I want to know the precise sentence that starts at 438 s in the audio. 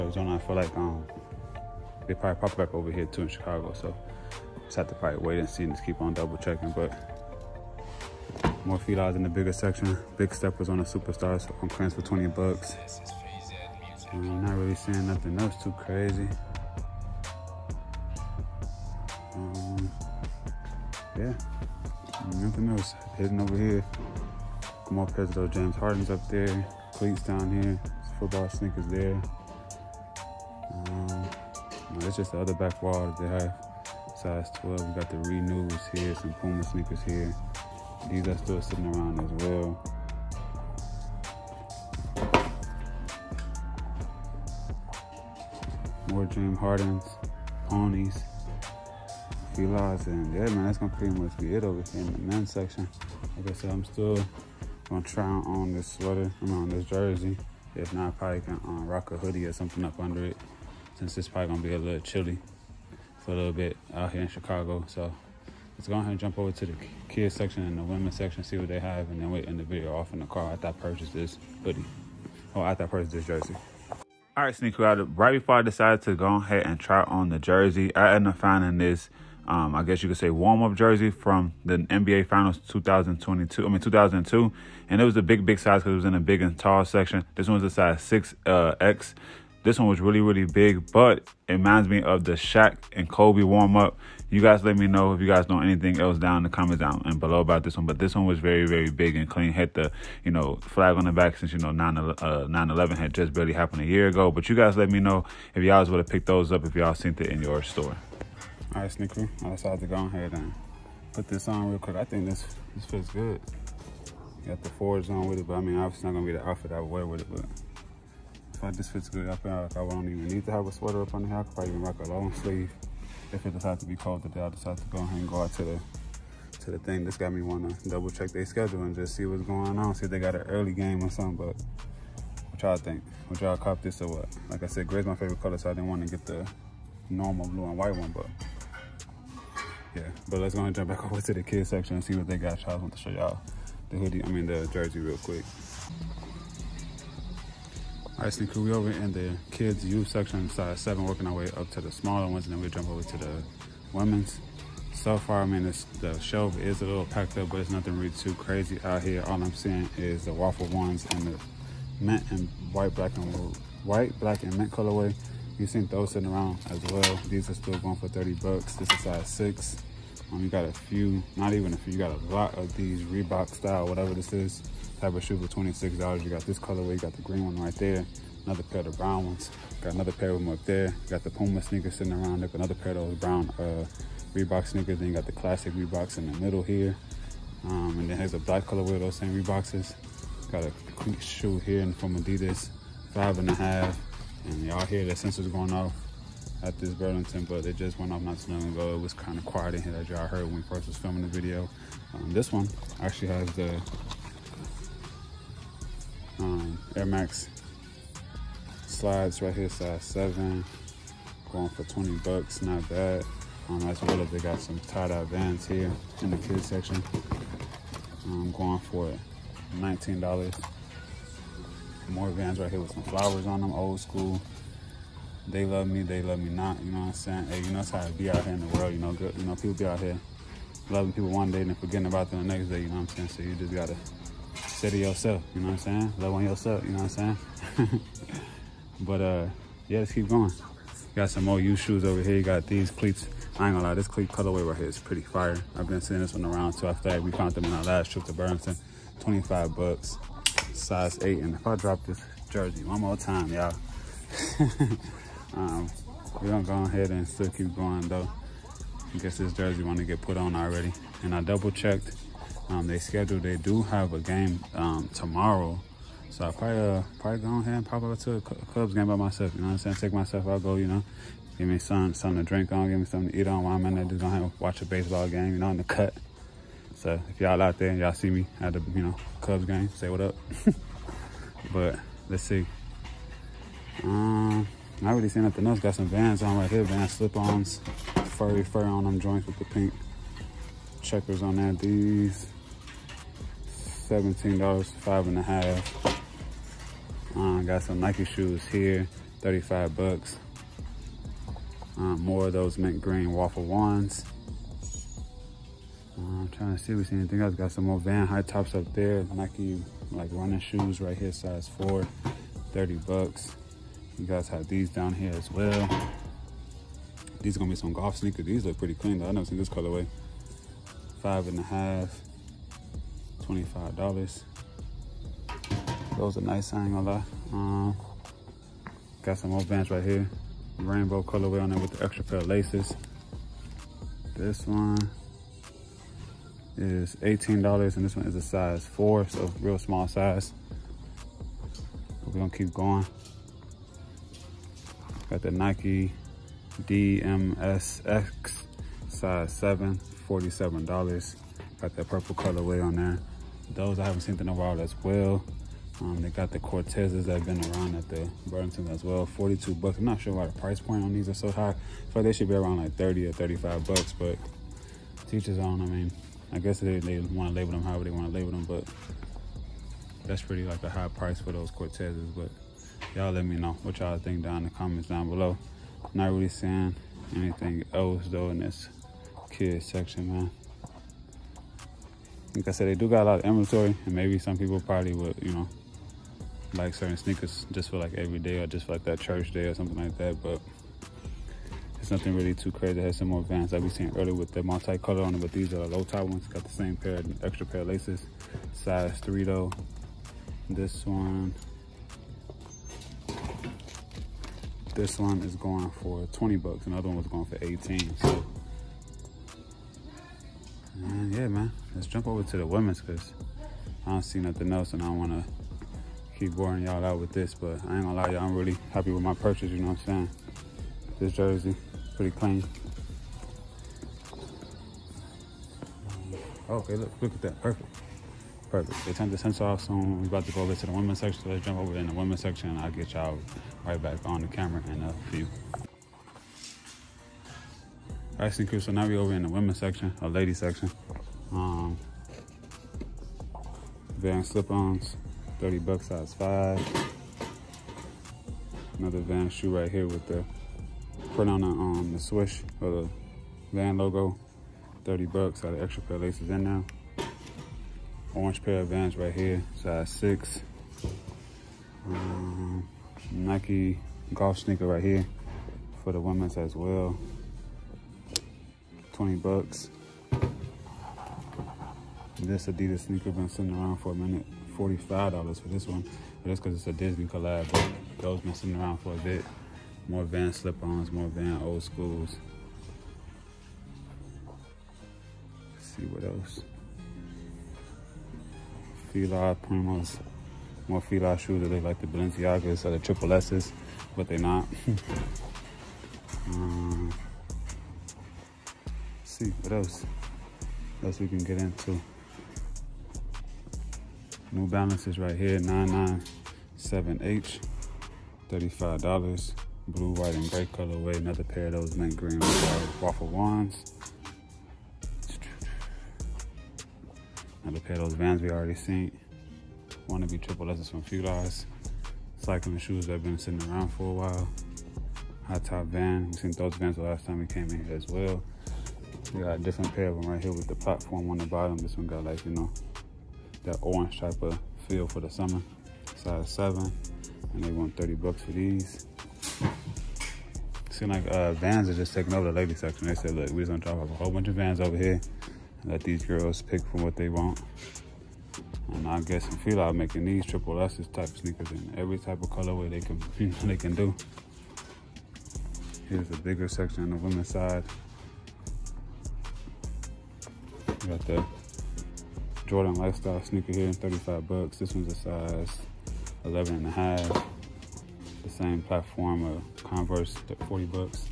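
All right, crew, so now we over in the women's section, a ladies section.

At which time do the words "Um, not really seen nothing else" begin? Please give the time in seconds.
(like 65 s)
284 s.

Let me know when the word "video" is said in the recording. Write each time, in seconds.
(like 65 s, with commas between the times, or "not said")
69 s, 201 s.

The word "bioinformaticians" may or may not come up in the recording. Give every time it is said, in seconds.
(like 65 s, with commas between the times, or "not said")
not said.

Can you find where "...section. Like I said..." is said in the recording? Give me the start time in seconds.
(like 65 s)
52 s.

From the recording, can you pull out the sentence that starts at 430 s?
We about to go over to the women's section.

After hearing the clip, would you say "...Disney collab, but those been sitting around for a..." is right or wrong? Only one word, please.
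right.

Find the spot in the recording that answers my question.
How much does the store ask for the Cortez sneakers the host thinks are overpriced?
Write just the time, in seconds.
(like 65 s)
359 s.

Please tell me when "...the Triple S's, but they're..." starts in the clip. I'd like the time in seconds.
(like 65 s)
492 s.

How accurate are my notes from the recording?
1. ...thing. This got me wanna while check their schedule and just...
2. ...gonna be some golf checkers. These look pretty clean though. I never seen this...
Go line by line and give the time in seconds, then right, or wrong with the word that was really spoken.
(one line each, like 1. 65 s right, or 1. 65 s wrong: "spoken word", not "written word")
1. 126 s wrong: "double", not "while"
2. 317 s wrong: "sneakers", not "checkers".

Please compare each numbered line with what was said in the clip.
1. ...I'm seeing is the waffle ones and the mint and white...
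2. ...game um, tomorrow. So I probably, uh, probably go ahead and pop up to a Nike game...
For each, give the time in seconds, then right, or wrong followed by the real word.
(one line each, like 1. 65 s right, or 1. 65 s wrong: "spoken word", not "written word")
1. 159 s right
2. 264 s wrong: "Cubs", not "Nike".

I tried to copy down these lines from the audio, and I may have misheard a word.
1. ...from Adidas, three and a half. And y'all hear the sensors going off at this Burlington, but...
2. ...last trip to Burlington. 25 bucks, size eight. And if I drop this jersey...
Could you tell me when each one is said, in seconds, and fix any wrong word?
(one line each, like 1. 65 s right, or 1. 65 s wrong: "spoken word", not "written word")
1. 191 s wrong: "five", not "three"
2. 247 s right.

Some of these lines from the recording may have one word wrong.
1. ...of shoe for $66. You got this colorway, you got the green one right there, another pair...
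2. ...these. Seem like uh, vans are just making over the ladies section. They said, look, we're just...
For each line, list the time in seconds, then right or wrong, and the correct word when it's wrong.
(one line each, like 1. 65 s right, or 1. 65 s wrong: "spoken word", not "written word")
1. 175 s wrong: "26", not "66"
2. 538 s wrong: "taking", not "making".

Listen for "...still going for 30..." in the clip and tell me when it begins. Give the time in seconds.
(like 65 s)
167 s.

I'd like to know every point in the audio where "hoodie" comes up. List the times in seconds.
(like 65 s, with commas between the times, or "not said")
59 s, 71 s, 143 s.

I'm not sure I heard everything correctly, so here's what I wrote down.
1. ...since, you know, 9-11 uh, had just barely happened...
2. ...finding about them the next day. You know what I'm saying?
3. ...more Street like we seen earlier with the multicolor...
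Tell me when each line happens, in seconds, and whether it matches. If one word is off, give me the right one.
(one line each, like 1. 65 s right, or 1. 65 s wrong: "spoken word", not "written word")
1. 101 s right
2. 231 s wrong: "forgetting", not "finding"
3. 393 s wrong: "Vans", not "Street".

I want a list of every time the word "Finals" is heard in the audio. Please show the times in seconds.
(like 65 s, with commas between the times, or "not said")
82 s.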